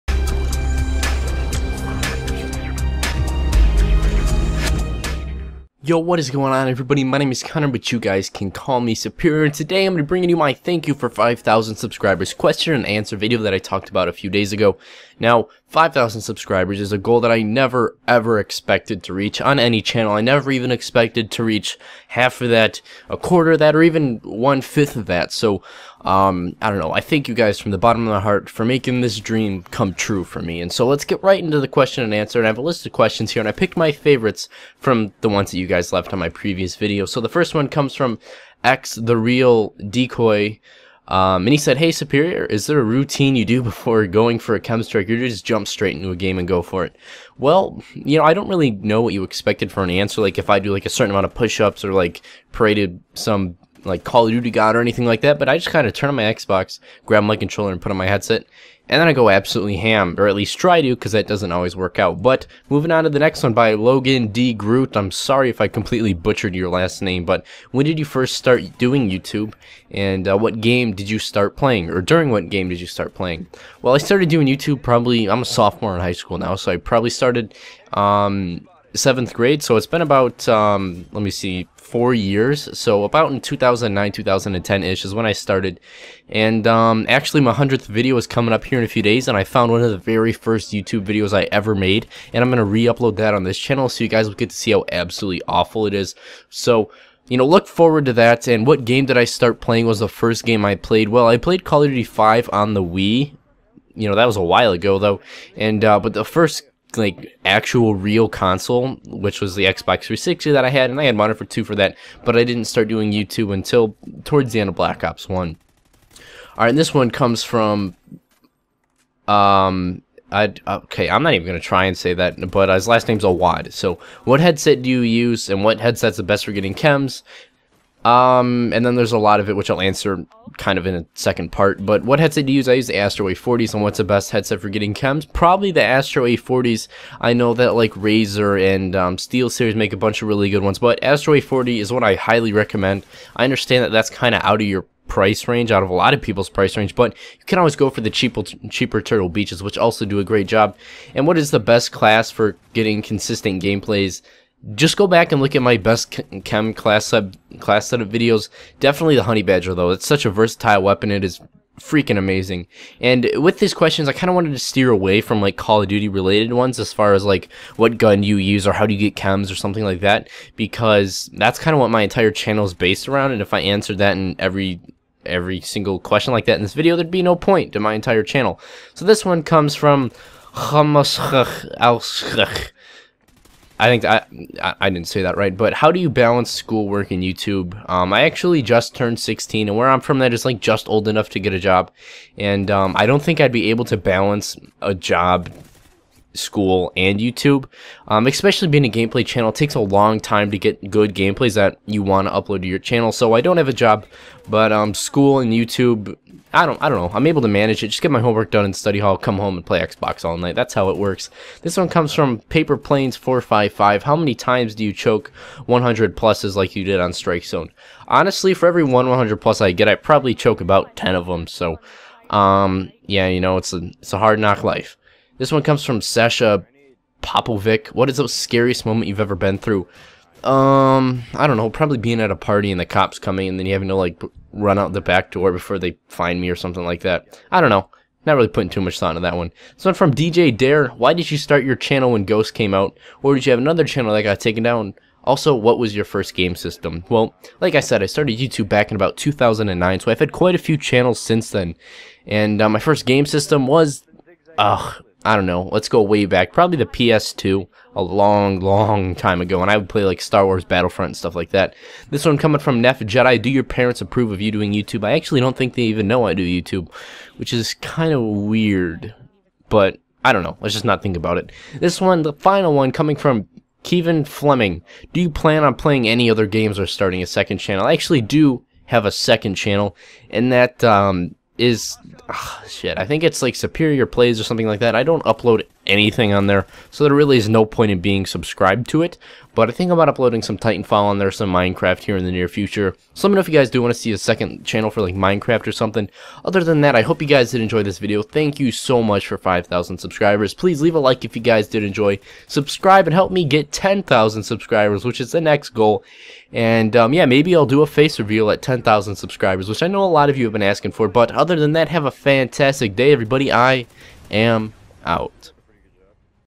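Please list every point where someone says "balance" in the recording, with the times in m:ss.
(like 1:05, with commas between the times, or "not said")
3:06, 3:13.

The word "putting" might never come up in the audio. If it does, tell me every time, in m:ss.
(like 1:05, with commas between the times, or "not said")
3:58.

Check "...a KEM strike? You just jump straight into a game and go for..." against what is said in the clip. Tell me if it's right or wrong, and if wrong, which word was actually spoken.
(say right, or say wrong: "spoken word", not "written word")
right.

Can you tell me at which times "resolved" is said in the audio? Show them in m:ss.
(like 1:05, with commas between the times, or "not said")
not said.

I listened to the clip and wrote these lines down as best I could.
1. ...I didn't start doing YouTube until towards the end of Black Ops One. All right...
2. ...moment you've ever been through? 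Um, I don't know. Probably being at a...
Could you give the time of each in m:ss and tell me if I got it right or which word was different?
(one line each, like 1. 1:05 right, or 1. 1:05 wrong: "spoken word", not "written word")
1. 1:52 right
2. 3:48 right.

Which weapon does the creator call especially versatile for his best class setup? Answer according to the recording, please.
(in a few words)
Honey Badger.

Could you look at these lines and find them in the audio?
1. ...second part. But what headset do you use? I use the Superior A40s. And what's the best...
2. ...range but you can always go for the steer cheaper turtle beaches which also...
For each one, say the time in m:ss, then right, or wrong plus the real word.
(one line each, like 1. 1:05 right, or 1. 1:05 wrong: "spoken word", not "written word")
1. 2:11 wrong: "Astro", not "Superior"
2. 2:26 wrong: "cheaper", not "steer".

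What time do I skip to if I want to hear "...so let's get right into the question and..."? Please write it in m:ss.
0:30.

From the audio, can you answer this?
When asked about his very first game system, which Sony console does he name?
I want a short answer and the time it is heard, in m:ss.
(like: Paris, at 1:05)
PS2, at 4:16.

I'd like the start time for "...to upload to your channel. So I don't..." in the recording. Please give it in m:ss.
3:22.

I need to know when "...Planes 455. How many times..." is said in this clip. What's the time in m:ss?
3:32.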